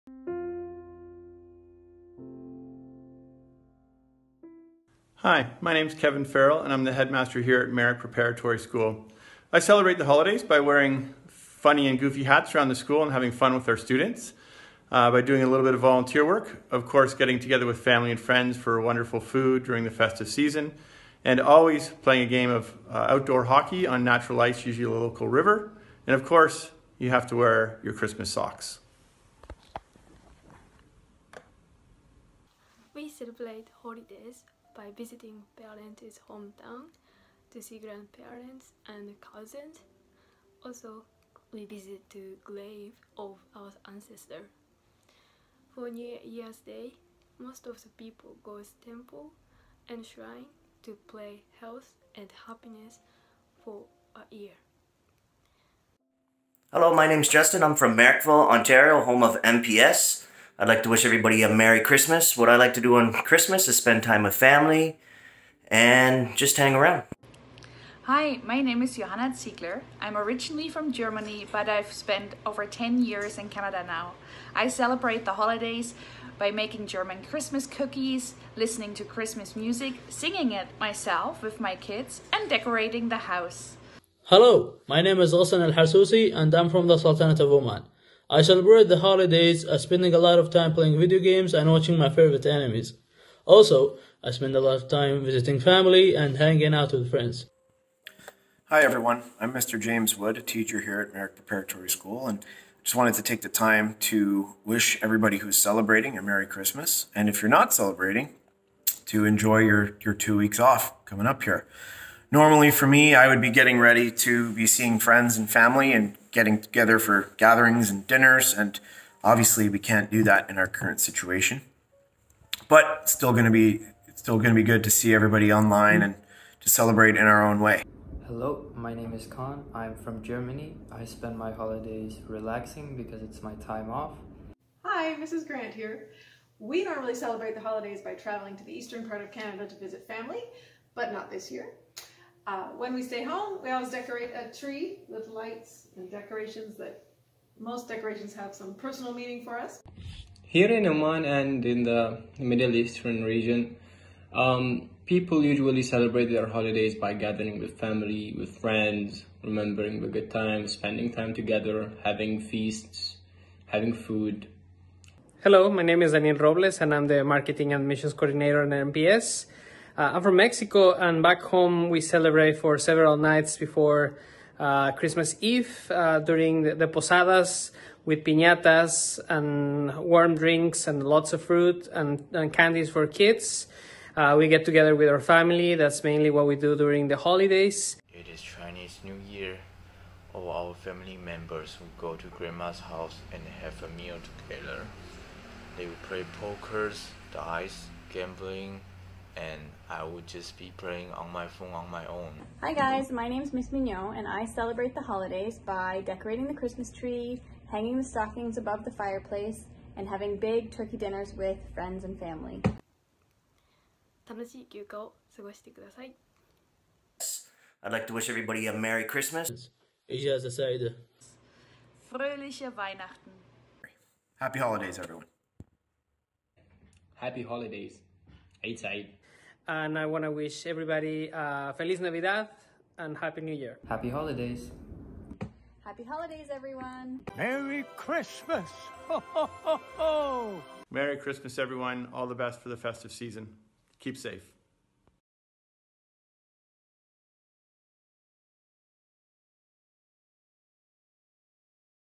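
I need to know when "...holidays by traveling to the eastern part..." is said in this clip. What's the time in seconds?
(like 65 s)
137 s.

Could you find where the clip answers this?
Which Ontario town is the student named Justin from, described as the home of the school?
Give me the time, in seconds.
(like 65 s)
57 s.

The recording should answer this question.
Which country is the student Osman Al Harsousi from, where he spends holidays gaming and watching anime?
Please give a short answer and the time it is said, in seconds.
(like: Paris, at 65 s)
Sultanate of Oman, at 86 s.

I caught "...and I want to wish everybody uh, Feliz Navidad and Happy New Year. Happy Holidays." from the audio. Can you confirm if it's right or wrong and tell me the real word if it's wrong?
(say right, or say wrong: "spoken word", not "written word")
right.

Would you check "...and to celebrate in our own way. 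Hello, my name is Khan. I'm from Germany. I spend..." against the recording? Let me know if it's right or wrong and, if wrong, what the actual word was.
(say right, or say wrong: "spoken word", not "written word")
right.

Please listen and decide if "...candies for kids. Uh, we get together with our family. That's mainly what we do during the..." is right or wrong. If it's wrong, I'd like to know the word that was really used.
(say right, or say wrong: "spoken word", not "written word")
right.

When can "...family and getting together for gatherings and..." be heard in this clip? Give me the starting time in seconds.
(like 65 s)
115 s.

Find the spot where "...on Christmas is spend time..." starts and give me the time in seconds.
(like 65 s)
62 s.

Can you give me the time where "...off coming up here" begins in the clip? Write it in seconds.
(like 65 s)
110 s.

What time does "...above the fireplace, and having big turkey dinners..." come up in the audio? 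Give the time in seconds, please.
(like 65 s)
208 s.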